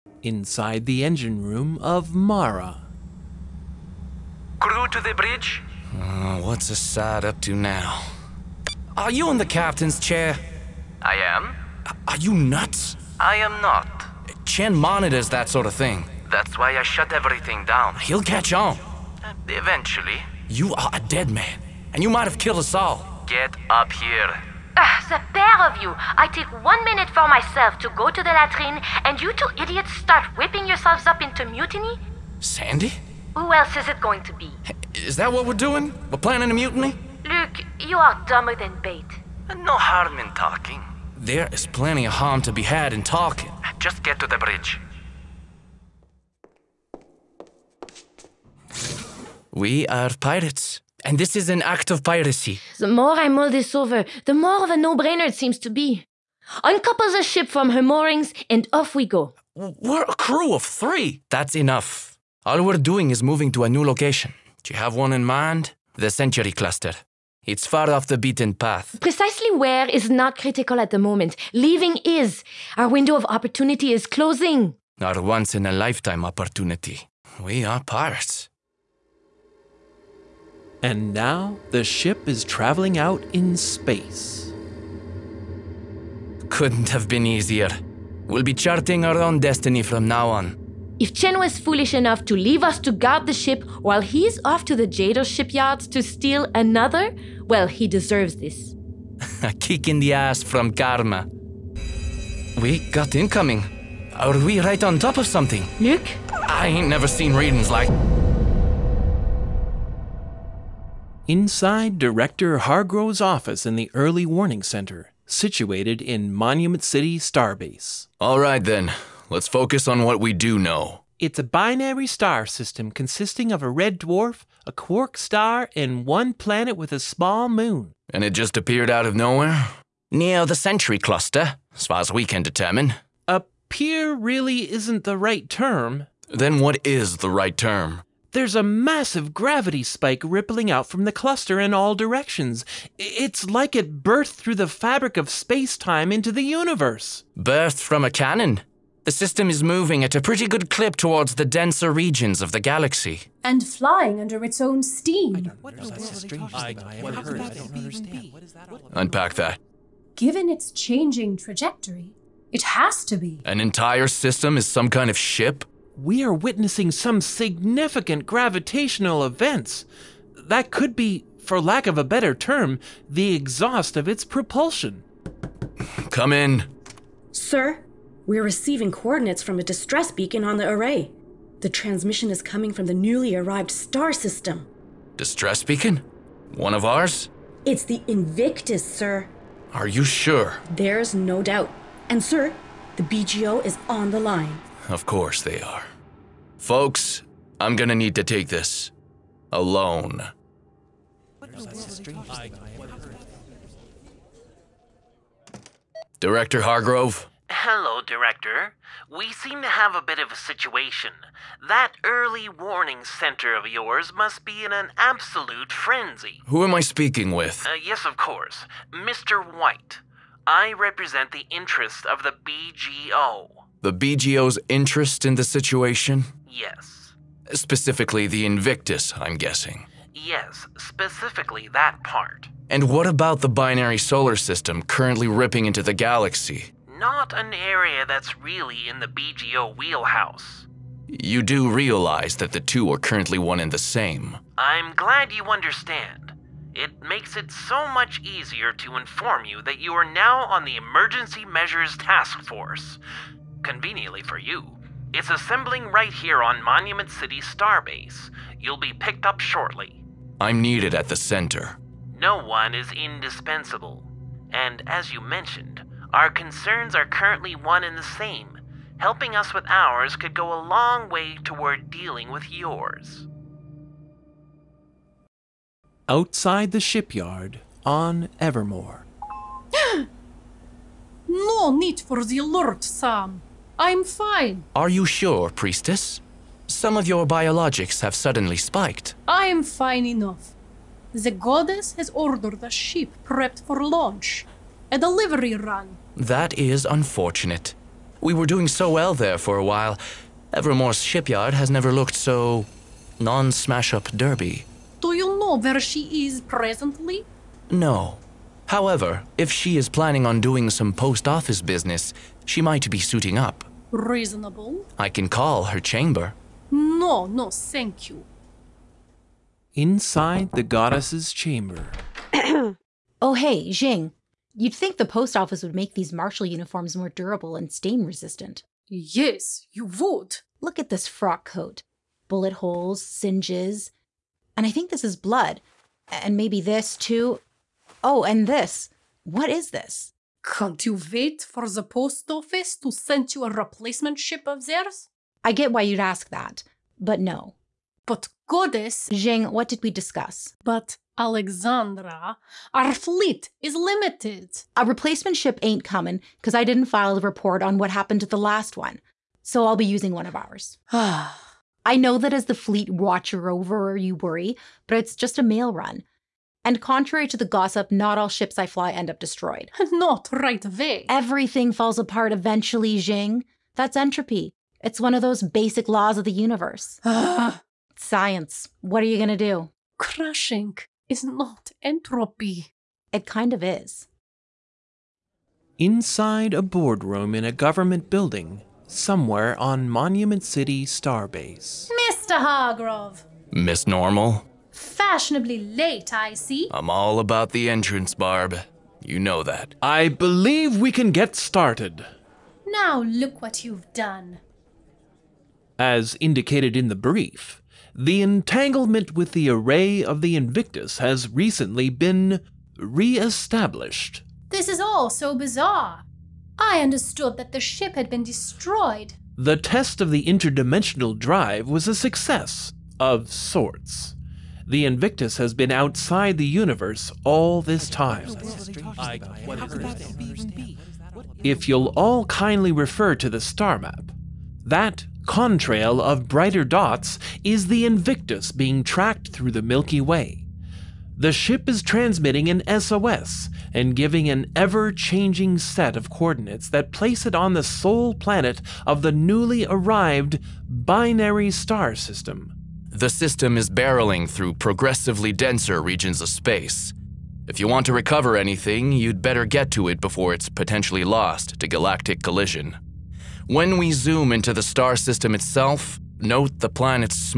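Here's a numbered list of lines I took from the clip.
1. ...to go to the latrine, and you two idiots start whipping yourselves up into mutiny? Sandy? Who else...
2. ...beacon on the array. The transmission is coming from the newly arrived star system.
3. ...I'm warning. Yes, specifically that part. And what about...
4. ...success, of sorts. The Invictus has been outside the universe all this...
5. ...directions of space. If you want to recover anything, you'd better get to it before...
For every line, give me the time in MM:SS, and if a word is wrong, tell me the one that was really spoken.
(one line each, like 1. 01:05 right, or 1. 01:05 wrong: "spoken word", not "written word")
1. 00:27 right
2. 03:00 right
3. 03:49 wrong: "guessing", not "warning"
4. 07:01 right
5. 07:35 wrong: "regions", not "directions".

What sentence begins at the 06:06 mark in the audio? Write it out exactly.
And contrary to the gossip, not all ships I fly end up destroyed.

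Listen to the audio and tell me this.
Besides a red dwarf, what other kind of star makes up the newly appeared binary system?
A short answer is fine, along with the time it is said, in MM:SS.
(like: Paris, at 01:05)
A quark star, at 02:04.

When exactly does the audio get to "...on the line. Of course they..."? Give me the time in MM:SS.
03:13.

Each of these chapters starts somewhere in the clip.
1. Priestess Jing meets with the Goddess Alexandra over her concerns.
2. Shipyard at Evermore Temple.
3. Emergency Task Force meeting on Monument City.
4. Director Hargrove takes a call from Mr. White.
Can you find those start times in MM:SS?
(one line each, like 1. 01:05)
1. 05:19
2. 04:35
3. 06:25
4. 03:24.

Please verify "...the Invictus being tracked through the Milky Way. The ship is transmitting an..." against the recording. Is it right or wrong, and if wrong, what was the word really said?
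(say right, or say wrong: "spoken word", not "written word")
right.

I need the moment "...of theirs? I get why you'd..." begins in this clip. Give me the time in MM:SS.
05:44.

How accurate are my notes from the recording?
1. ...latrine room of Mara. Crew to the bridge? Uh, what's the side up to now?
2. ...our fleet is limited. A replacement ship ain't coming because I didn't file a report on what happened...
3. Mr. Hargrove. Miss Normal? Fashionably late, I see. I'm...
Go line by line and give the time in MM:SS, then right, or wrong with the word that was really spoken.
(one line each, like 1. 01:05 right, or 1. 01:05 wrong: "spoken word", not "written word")
1. 00:01 wrong: "engine", not "latrine"
2. 05:52 right
3. 06:32 right.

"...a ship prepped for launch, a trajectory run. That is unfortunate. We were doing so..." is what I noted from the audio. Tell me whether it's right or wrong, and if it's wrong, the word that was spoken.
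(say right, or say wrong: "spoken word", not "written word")
wrong: "delivery", not "trajectory".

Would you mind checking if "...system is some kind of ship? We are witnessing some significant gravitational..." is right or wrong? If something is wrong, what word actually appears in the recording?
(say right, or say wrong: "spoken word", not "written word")
right.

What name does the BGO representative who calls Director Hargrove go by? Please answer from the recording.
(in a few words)
Mr. White.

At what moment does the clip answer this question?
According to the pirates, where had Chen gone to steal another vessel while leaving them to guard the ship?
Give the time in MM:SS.
01:34.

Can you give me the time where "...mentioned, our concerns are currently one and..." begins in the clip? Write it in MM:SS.
04:25.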